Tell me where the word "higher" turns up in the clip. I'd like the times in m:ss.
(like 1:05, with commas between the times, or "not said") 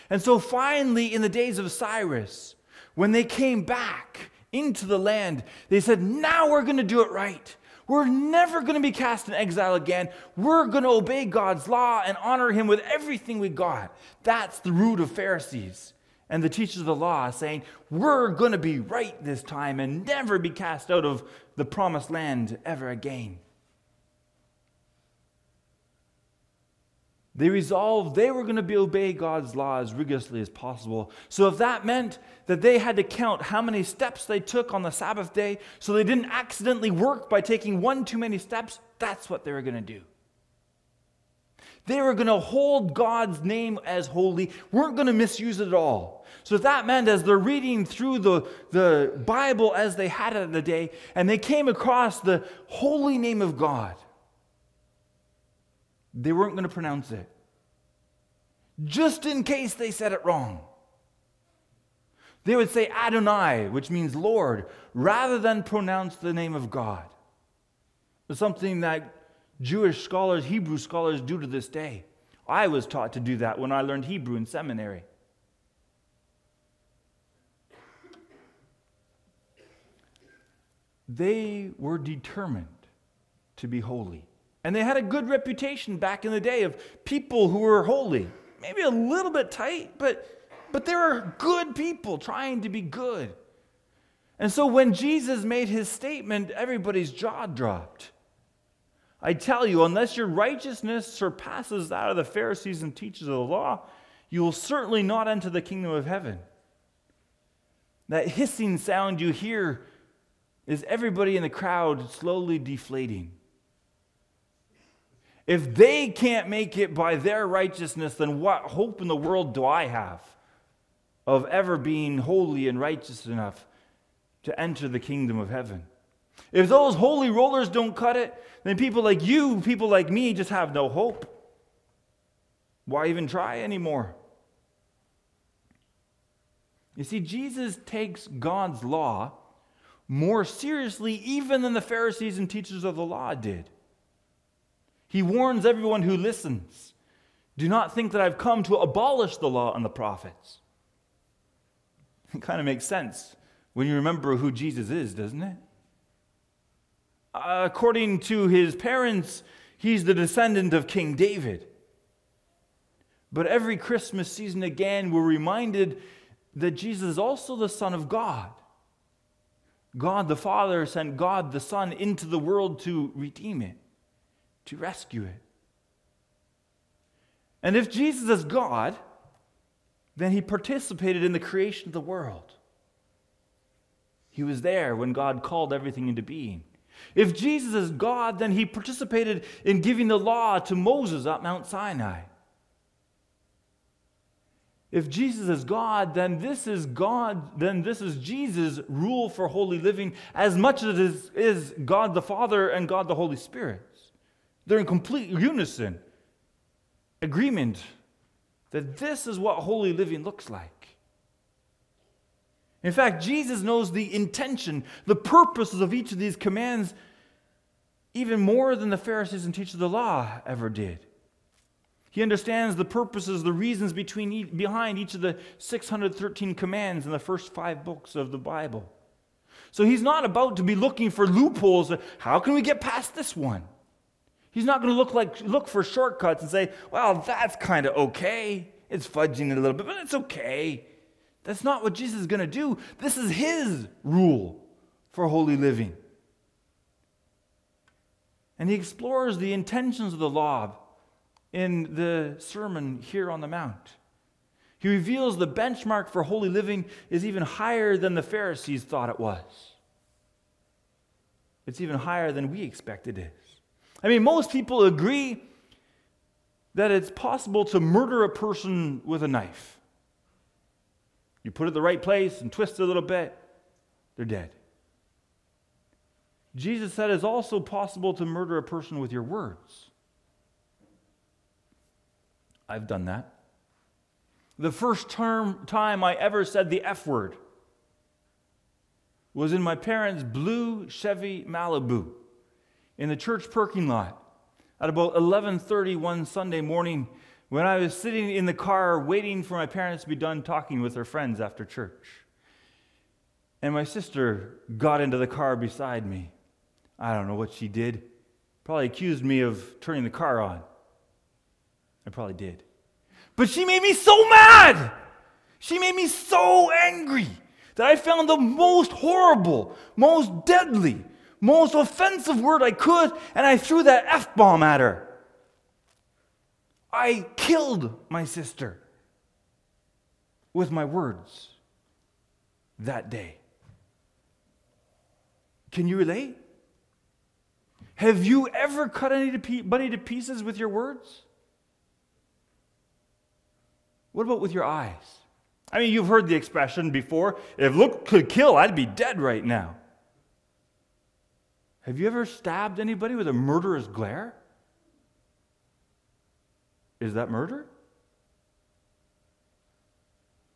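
4:17, 4:21.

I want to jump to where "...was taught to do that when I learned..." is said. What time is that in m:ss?
1:12.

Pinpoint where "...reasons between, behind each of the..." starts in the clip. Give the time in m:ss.
3:43.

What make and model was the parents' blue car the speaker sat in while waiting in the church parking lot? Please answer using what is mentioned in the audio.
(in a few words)
Chevy Malibu.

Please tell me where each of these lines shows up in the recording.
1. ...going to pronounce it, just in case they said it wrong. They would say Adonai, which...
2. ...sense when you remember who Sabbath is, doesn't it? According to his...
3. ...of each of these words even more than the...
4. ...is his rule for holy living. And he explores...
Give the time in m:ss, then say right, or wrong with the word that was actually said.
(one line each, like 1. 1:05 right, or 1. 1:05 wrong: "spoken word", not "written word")
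1. 0:56 right
2. 2:32 wrong: "Jesus", not "Sabbath"
3. 3:35 wrong: "commands", not "words"
4. 4:03 right.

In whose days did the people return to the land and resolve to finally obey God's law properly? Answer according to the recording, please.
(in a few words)
Cyrus.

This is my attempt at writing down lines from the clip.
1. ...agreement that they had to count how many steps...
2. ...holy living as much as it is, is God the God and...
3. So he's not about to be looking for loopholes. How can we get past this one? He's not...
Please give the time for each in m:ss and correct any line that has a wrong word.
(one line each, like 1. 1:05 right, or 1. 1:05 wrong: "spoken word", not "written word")
1. 0:31 wrong: "meant", not "agreement"
2. 3:19 wrong: "Father", not "God"
3. 3:49 right.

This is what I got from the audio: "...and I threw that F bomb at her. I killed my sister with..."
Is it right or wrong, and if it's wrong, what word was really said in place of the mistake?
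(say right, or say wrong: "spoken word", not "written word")
right.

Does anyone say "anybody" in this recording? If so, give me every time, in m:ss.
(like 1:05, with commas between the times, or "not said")
5:39, 5:52.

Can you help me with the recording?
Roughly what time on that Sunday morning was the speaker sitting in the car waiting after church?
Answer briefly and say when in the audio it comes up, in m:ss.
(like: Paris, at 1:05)
11:30, at 4:55.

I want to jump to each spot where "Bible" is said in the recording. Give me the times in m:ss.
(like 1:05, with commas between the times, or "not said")
0:49, 3:48.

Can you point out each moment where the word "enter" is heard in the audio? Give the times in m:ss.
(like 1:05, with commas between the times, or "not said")
1:45, 2:04.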